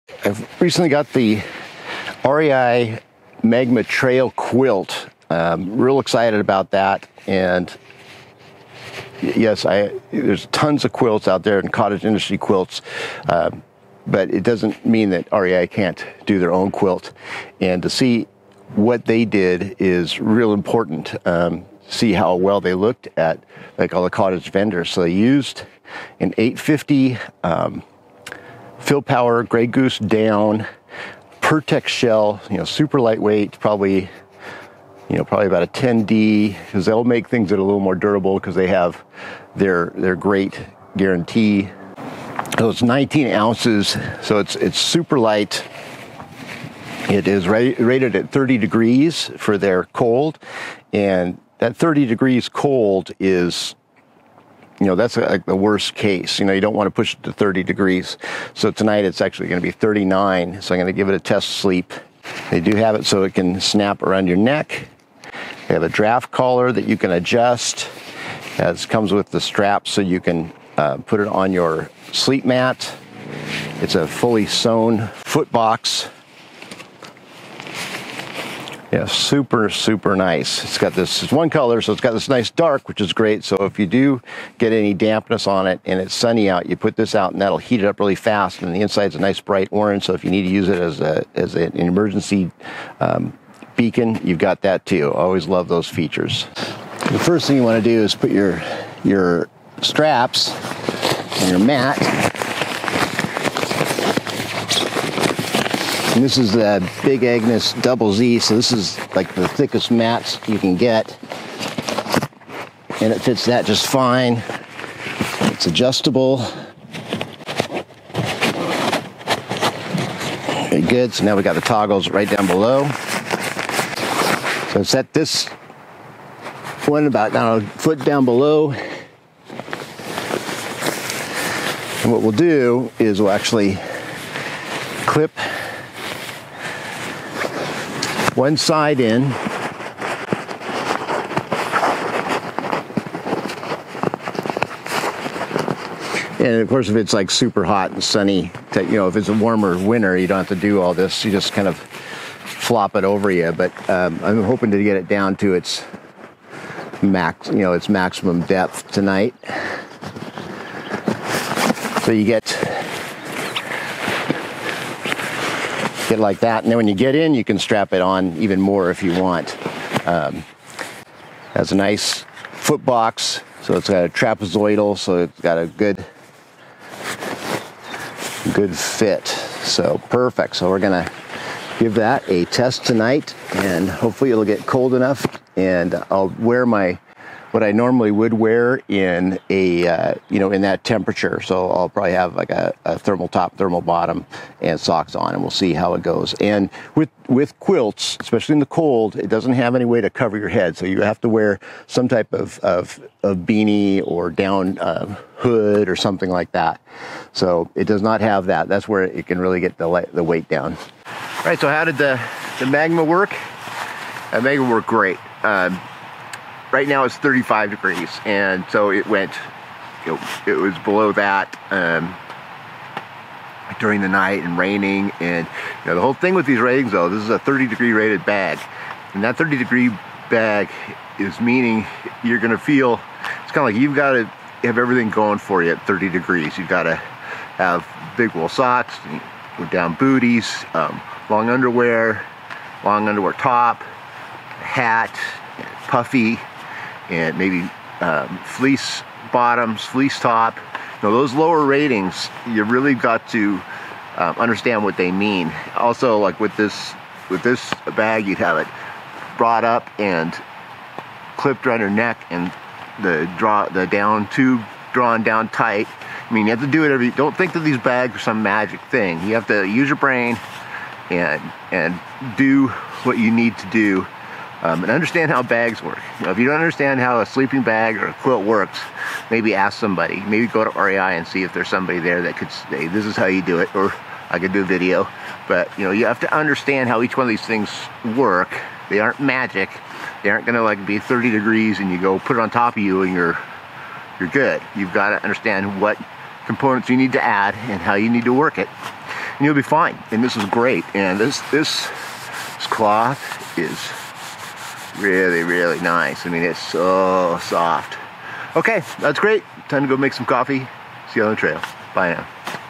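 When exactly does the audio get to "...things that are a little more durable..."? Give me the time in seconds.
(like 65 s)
37 s.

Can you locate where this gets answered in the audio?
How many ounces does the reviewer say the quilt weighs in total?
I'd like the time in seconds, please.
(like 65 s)
42 s.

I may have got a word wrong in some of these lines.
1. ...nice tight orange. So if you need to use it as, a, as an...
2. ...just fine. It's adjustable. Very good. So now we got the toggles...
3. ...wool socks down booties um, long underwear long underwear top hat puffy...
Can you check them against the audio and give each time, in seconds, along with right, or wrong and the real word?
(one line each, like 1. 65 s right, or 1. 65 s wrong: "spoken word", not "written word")
1. 89 s wrong: "bright", not "tight"
2. 113 s right
3. 238 s right.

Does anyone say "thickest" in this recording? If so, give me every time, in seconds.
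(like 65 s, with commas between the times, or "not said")
109 s.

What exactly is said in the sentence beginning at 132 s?
And what we'll do is we'll actually clip one side in.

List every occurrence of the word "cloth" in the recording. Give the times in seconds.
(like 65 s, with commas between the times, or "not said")
302 s.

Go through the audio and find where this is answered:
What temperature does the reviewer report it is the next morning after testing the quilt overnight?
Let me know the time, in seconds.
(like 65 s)
217 s.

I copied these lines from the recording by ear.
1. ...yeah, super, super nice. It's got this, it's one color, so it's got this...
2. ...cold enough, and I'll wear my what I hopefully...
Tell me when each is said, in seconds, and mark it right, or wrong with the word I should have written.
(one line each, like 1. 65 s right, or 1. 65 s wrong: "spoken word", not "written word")
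1. 78 s right
2. 184 s wrong: "normally", not "hopefully".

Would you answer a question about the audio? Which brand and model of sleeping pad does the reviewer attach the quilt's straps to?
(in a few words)
Big Agnes Double Z.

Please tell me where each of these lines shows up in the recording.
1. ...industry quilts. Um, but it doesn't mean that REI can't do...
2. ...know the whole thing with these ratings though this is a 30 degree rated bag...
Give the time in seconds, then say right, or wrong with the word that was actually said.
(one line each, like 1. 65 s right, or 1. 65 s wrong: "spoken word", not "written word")
1. 12 s right
2. 225 s right.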